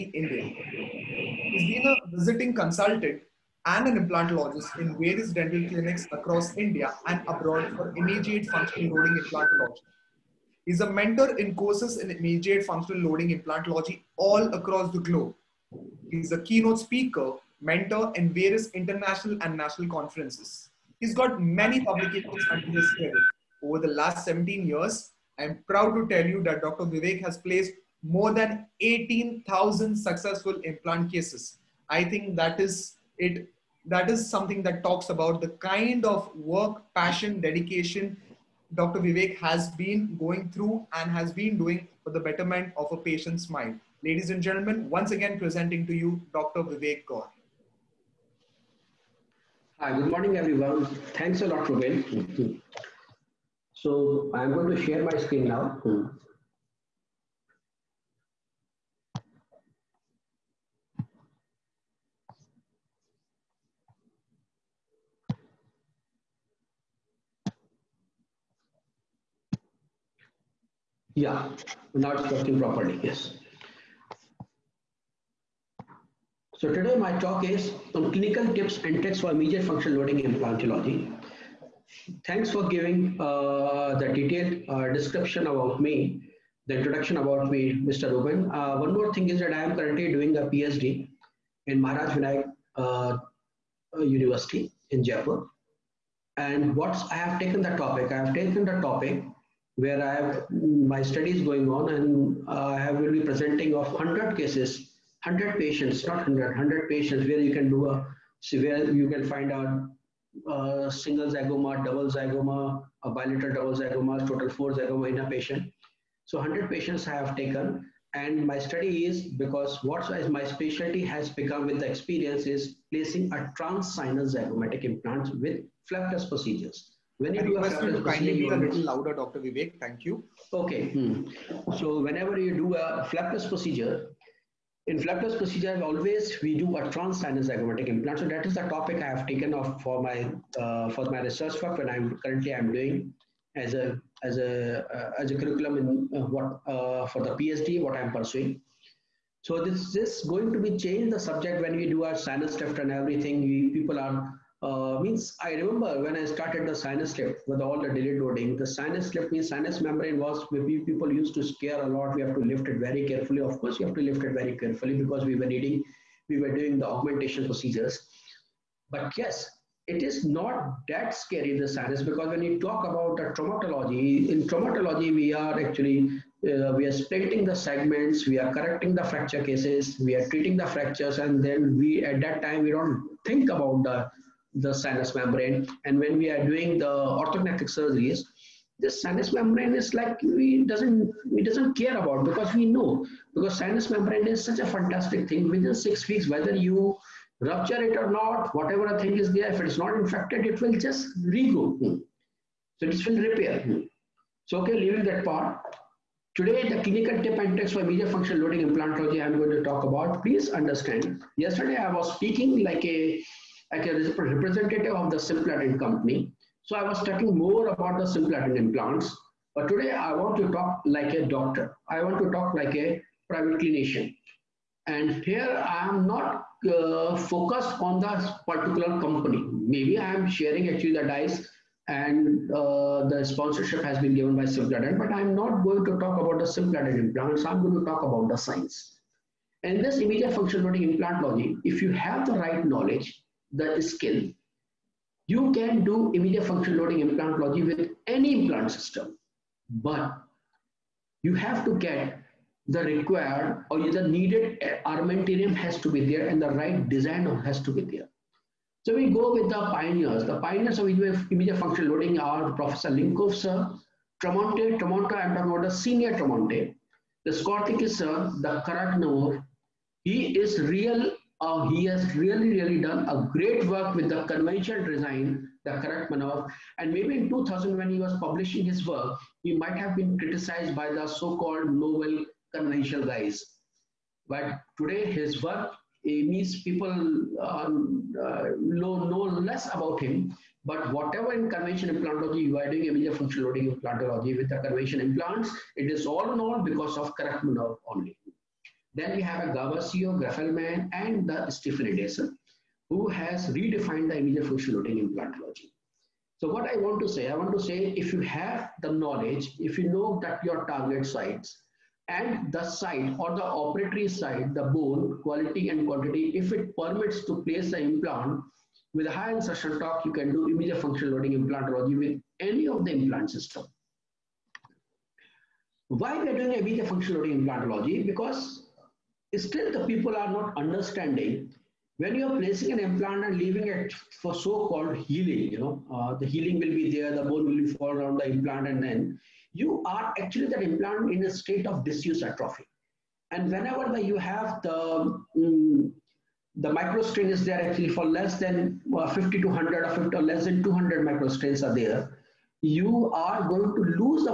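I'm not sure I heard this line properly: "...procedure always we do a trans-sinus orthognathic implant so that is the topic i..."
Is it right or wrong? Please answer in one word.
wrong.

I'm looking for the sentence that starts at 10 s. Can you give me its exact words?
He's a mentor in courses in immediate functional loading implantology all across the globe.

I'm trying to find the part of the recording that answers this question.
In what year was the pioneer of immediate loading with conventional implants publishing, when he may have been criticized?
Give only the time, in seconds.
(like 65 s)
277 s.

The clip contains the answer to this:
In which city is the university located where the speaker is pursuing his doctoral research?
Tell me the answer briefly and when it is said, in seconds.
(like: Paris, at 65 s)
Jaipur, at 95 s.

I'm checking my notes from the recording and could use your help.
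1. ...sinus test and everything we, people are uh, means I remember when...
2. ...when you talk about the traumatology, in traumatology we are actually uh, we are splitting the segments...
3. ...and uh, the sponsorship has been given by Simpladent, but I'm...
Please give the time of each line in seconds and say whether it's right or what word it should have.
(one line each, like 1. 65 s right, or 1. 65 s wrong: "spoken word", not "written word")
1. 152 s right
2. 172 s right
3. 231 s right.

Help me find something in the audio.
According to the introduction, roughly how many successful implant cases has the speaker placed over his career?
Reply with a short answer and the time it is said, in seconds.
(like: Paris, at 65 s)
more than 18,000, at 28 s.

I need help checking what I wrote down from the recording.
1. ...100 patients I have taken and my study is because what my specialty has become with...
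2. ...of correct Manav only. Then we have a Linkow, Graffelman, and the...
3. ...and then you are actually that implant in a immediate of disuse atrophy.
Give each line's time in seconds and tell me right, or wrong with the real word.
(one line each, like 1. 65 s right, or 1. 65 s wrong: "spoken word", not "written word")
1. 116 s right
2. 296 s wrong: "Gavasio", not "Linkow"
3. 338 s wrong: "state", not "immediate".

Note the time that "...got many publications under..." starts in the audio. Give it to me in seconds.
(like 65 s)
21 s.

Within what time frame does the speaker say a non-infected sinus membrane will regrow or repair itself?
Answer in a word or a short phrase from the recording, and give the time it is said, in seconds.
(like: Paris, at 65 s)
six weeks, at 195 s.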